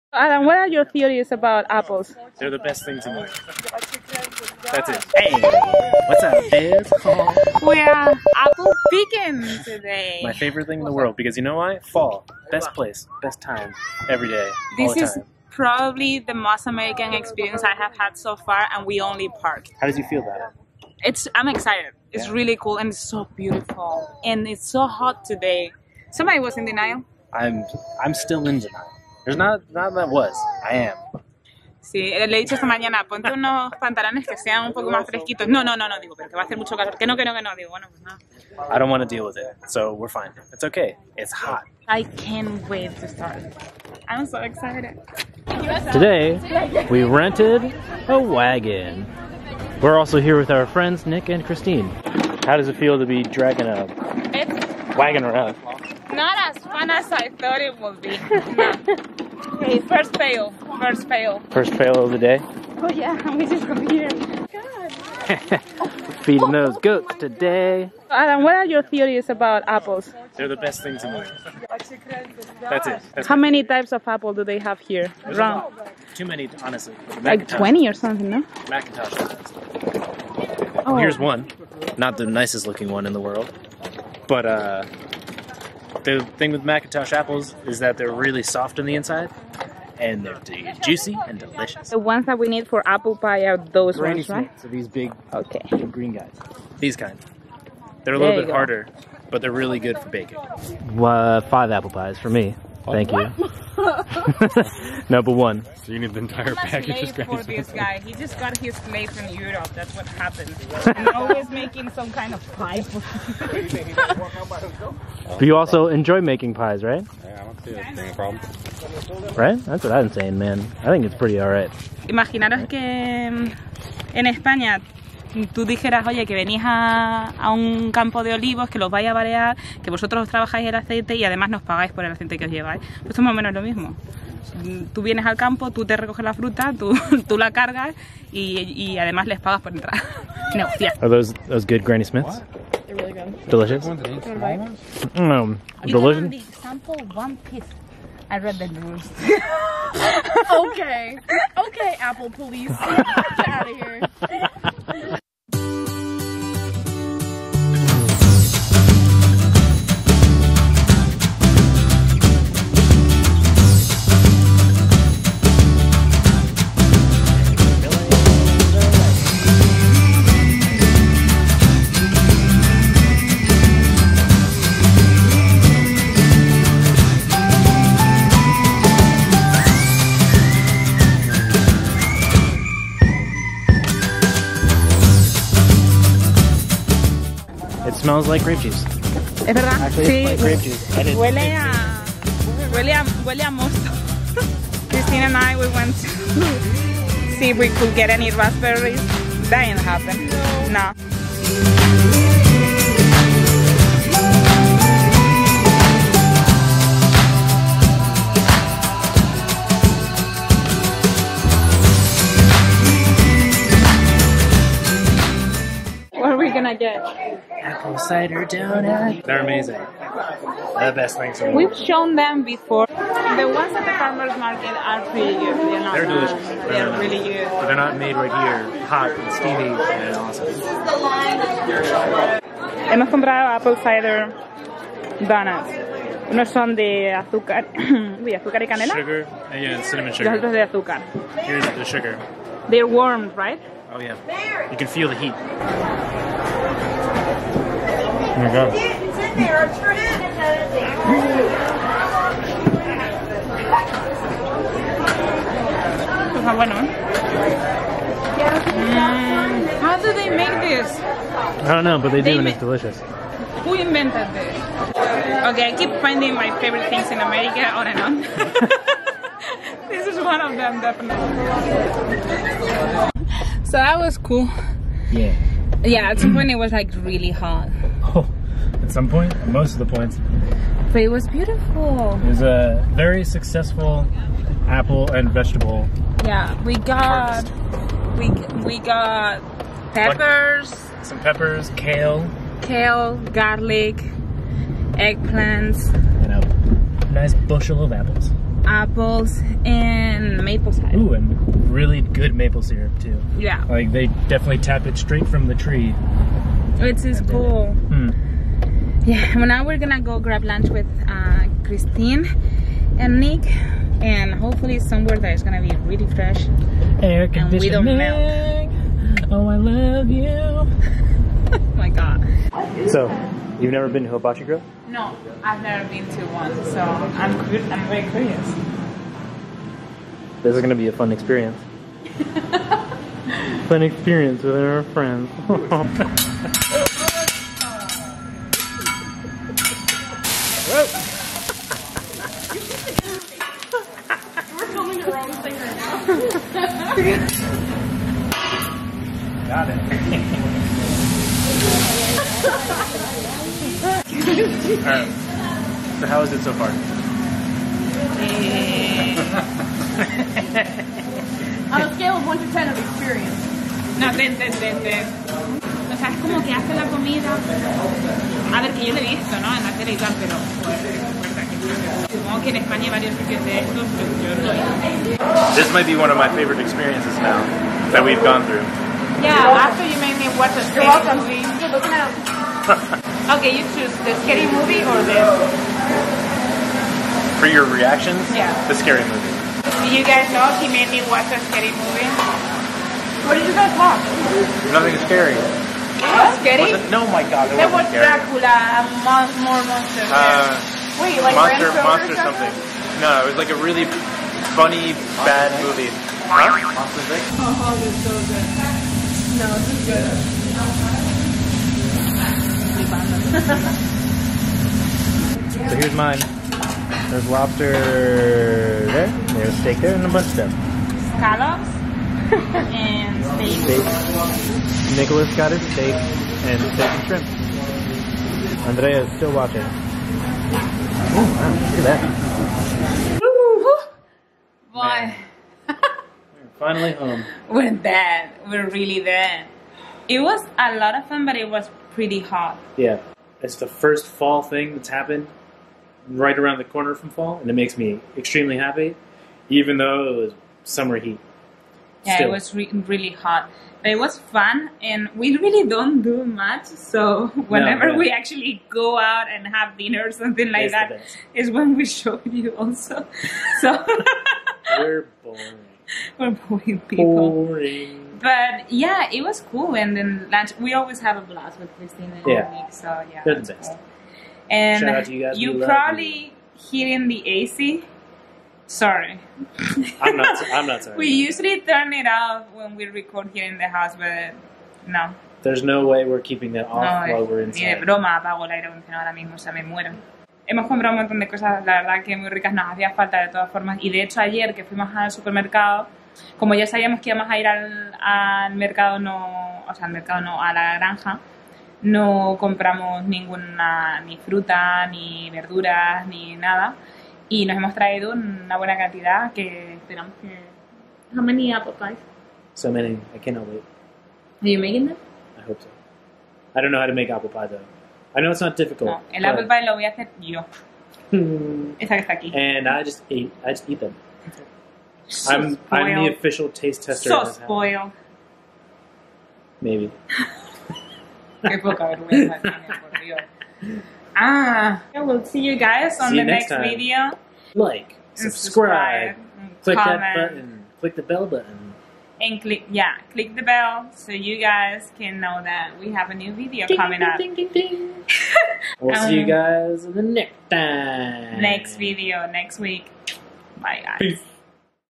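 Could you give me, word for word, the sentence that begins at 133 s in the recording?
Pues es más o menos lo mismo.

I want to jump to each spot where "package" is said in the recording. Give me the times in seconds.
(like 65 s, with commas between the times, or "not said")
106 s.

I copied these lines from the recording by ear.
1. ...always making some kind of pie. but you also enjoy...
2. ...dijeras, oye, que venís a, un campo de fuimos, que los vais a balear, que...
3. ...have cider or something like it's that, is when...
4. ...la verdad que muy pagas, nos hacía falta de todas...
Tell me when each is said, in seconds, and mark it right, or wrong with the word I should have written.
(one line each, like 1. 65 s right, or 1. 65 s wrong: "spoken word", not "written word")
1. 111 s right
2. 125 s wrong: "olivos", not "fuimos"
3. 459 s wrong: "dinner", not "cider"
4. 491 s wrong: "ricas", not "pagas".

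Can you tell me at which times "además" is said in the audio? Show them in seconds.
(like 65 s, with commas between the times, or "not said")
131 s, 138 s.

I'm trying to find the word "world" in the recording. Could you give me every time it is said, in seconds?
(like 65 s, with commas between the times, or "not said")
10 s, 83 s, 221 s.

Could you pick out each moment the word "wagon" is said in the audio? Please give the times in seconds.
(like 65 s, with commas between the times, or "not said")
48 s, 54 s.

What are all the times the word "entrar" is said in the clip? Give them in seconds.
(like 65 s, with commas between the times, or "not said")
139 s.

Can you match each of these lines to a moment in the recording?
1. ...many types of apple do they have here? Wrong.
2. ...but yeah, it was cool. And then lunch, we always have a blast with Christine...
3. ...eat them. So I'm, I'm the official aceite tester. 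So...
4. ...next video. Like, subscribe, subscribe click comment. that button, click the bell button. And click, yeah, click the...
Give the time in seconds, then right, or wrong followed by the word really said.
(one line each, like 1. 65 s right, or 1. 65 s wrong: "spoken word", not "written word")
1. 73 s right
2. 468 s right
3. 523 s wrong: "taste", not "aceite"
4. 536 s right.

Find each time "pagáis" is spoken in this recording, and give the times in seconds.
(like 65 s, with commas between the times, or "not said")
131 s.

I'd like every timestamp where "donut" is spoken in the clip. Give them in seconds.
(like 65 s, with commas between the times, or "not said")
218 s, 235 s.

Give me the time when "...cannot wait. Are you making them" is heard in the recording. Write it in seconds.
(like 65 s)
513 s.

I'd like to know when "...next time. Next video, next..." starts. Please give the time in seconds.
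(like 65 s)
550 s.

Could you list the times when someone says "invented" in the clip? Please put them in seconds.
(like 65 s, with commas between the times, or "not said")
263 s.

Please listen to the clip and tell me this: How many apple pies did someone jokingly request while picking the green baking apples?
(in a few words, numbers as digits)
5.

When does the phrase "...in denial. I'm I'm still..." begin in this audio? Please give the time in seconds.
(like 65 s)
26 s.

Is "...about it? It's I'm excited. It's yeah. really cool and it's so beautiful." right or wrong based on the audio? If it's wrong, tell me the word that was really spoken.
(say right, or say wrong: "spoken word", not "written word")
right.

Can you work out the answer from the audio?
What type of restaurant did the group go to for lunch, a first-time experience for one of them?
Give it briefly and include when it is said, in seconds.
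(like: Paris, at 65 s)
Hibachi Grill, at 324 s.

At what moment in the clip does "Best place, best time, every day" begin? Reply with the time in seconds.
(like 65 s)
12 s.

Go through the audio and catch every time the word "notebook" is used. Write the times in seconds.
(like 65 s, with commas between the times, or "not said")
not said.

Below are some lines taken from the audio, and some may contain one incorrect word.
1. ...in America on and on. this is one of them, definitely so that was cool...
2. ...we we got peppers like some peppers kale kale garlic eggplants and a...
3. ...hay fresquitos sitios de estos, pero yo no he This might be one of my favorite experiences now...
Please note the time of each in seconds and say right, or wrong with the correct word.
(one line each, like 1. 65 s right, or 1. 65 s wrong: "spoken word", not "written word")
1. 267 s right
2. 288 s right
3. 372 s wrong: "varios", not "fresquitos".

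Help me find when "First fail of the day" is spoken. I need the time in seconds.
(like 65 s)
61 s.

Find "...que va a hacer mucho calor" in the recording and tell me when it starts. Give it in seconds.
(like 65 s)
36 s.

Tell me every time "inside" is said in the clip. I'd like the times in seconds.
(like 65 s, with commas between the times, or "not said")
88 s, 487 s.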